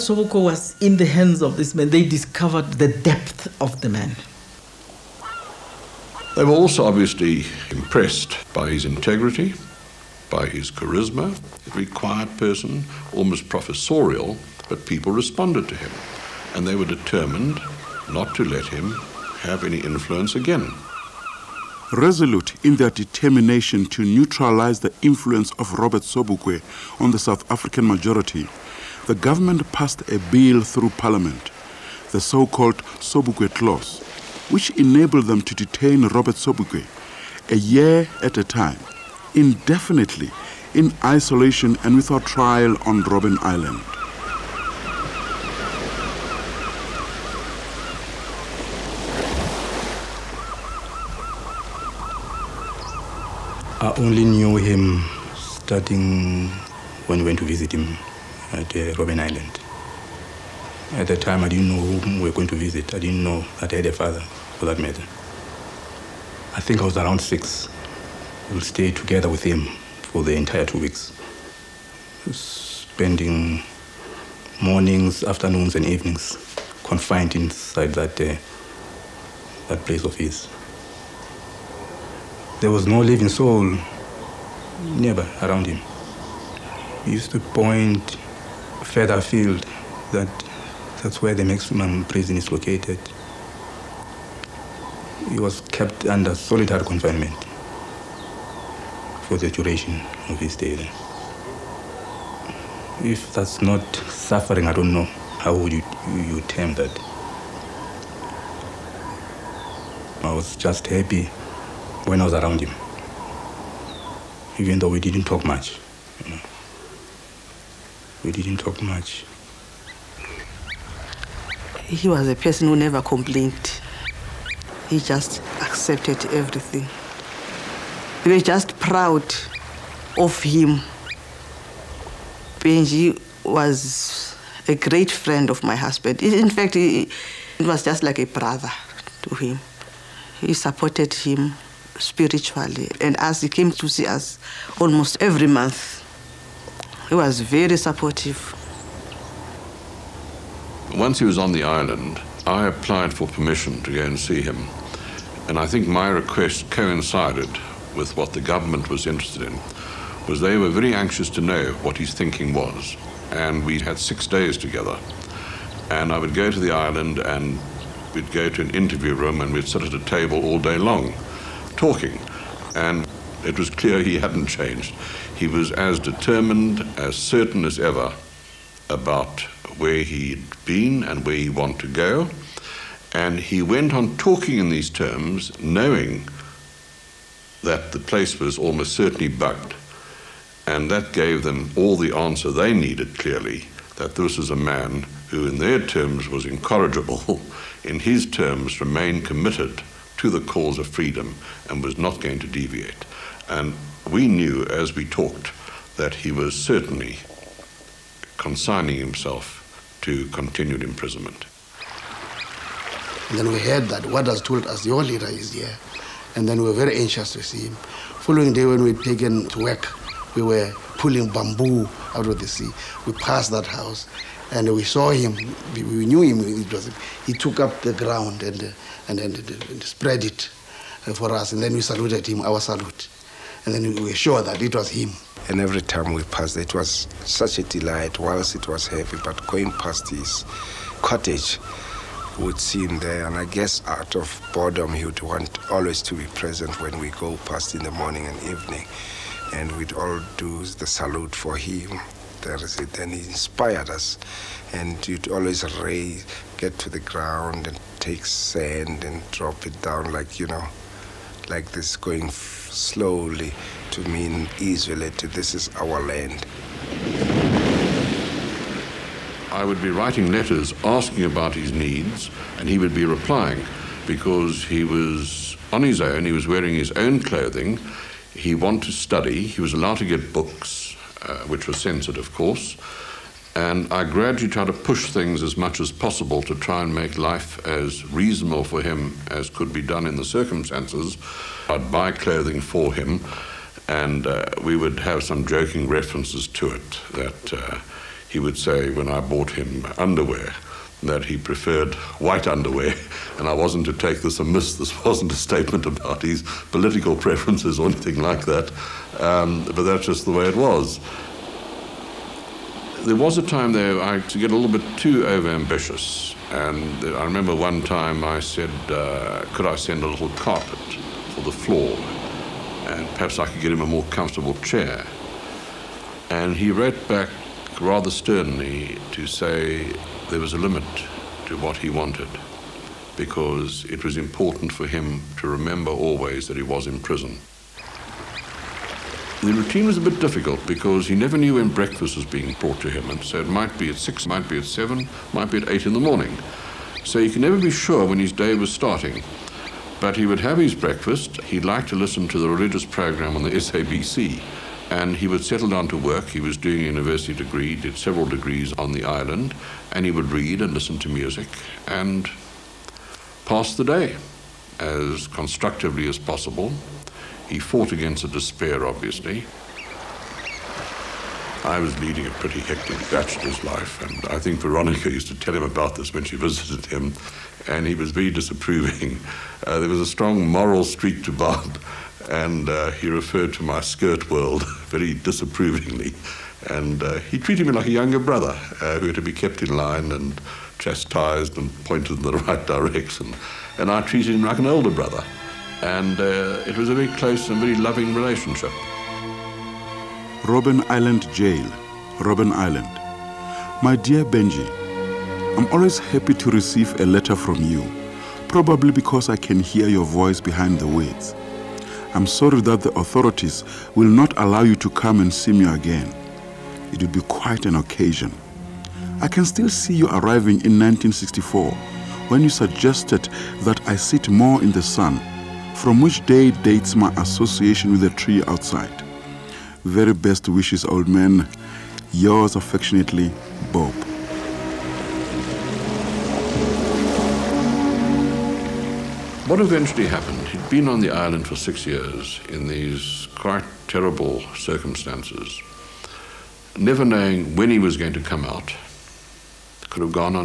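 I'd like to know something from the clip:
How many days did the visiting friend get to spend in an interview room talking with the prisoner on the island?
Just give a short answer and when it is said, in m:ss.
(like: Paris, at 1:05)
6, at 2:43.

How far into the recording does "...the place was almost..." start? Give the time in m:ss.
3:07.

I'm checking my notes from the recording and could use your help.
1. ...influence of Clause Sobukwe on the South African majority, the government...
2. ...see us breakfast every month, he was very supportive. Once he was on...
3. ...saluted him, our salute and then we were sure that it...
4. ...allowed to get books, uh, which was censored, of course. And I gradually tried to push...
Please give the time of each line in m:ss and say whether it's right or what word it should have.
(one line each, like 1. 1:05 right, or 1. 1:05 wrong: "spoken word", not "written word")
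1. 0:24 wrong: "Robert", not "Clause"
2. 2:23 wrong: "almost", not "breakfast"
3. 3:51 right
4. 4:39 right.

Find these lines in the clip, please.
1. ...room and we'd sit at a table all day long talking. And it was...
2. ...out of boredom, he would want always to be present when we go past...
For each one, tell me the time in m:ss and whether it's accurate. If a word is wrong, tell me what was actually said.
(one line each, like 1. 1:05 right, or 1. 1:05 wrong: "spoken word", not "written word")
1. 2:49 right
2. 4:03 right.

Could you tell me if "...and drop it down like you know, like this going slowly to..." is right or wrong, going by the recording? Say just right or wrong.
right.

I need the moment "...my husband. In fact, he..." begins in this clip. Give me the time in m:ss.
2:15.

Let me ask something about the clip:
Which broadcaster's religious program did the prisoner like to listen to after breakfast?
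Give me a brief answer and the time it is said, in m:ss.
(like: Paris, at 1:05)
SABC, at 5:53.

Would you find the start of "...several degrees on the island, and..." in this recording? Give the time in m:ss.
5:57.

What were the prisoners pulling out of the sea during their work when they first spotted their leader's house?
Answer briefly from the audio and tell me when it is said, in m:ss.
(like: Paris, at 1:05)
bamboo, at 3:41.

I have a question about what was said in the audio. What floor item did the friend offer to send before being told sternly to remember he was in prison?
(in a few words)
a little carpet.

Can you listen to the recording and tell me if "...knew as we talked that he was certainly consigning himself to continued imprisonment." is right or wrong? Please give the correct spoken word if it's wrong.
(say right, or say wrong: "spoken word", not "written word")
right.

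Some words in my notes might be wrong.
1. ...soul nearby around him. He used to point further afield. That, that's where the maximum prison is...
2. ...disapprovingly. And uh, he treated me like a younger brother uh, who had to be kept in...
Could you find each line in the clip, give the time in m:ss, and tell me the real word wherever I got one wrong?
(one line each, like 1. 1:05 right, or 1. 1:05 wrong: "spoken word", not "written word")
1. 1:23 right
2. 6:25 right.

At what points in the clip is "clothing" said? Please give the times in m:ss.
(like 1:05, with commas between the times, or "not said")
4:37, 4:52.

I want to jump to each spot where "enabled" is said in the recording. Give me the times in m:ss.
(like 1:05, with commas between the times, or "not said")
0:34.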